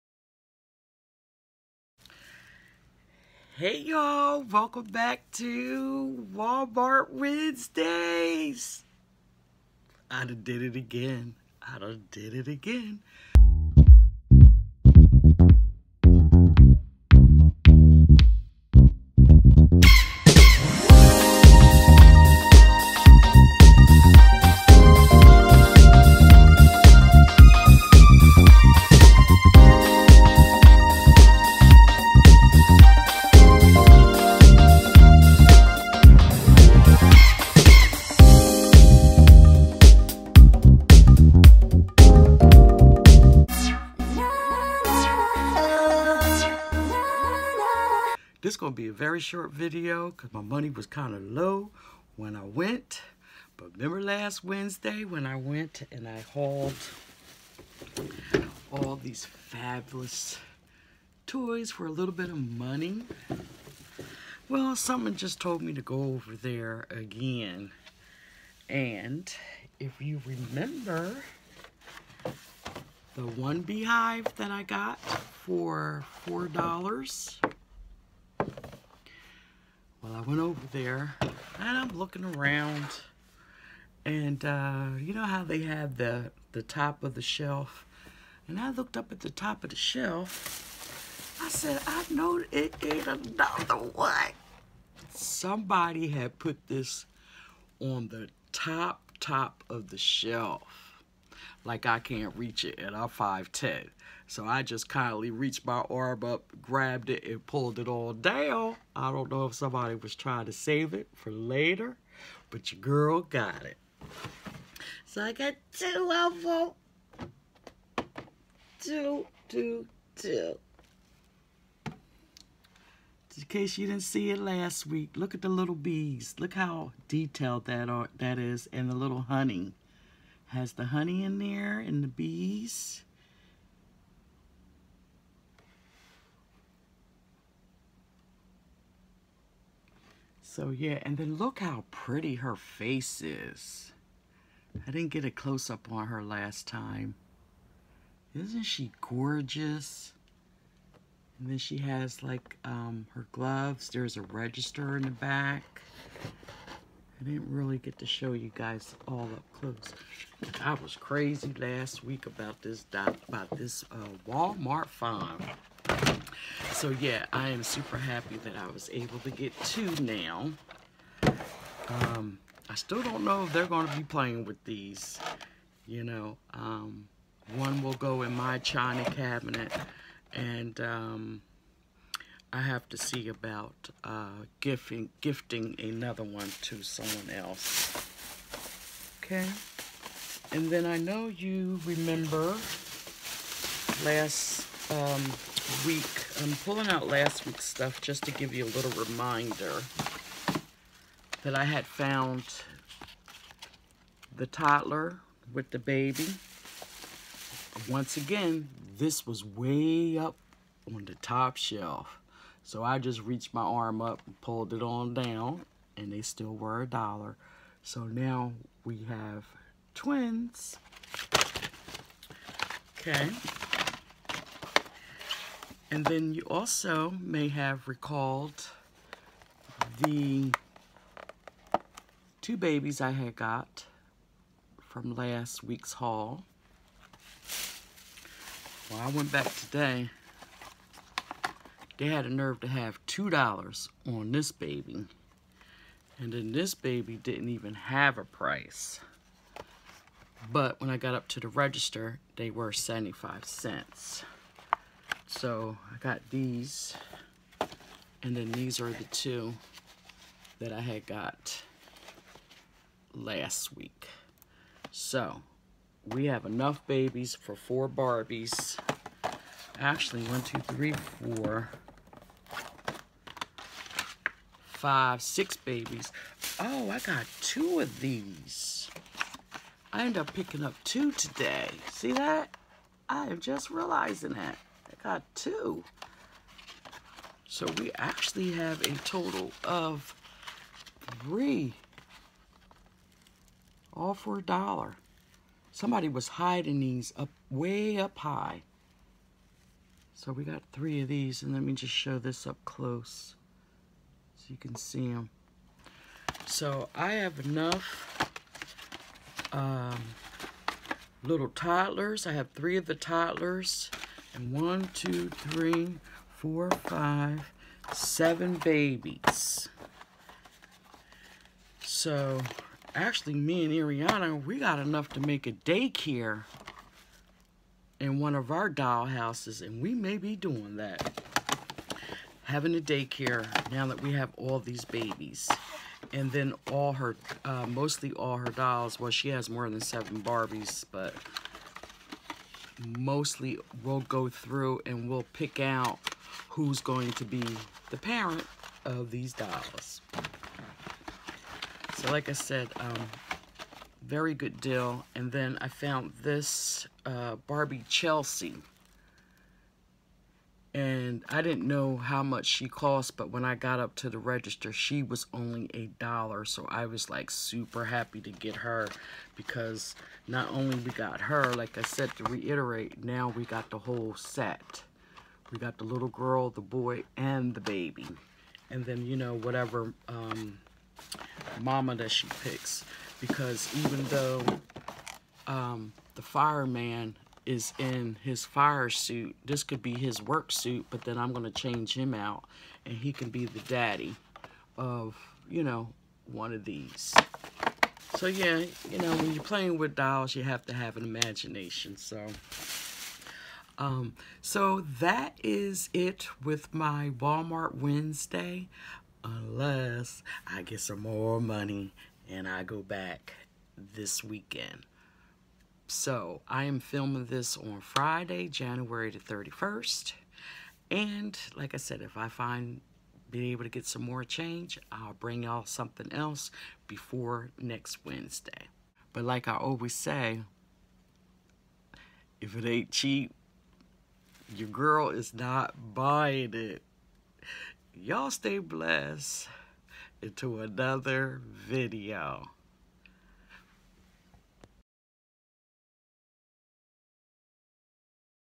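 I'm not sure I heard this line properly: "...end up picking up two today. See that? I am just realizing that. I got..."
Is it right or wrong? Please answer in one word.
right.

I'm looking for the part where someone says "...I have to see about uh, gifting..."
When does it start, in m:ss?
3:02.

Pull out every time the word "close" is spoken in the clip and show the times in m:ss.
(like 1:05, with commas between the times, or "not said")
2:25, 2:39, 5:02.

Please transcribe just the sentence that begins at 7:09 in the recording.
But like I always say, if it ain't cheap, your girl is not buying it.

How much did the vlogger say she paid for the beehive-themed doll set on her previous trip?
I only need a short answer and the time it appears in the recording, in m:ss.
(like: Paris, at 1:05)
$4, at 1:16.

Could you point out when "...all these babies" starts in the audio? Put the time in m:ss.
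5:34.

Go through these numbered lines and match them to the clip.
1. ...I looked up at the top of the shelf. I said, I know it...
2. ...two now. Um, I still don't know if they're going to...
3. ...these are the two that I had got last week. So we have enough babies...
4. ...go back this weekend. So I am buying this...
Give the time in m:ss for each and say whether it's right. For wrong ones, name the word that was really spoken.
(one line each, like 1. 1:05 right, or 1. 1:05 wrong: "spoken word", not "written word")
1. 1:28 right
2. 2:49 right
3. 4:18 right
4. 6:52 wrong: "filming", not "buying".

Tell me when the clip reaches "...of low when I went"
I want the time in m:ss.
0:51.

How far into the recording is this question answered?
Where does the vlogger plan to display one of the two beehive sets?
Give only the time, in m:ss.
2:58.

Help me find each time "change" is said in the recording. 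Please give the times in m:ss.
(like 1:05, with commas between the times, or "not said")
6:31, 7:04.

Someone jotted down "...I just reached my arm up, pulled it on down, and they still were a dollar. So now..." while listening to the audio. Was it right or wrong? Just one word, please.
right.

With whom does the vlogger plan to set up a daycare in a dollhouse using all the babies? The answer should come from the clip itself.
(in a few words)
Ariana.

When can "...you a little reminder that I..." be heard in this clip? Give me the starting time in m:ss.
3:18.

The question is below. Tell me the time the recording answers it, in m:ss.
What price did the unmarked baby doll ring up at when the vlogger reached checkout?
4:12.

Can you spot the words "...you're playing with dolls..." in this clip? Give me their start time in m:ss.
6:39.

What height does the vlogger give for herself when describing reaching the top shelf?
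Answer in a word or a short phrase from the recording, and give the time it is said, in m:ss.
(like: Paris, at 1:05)
5'10", at 1:43.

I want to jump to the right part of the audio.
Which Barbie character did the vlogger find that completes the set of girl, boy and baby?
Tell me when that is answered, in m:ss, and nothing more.
5:57.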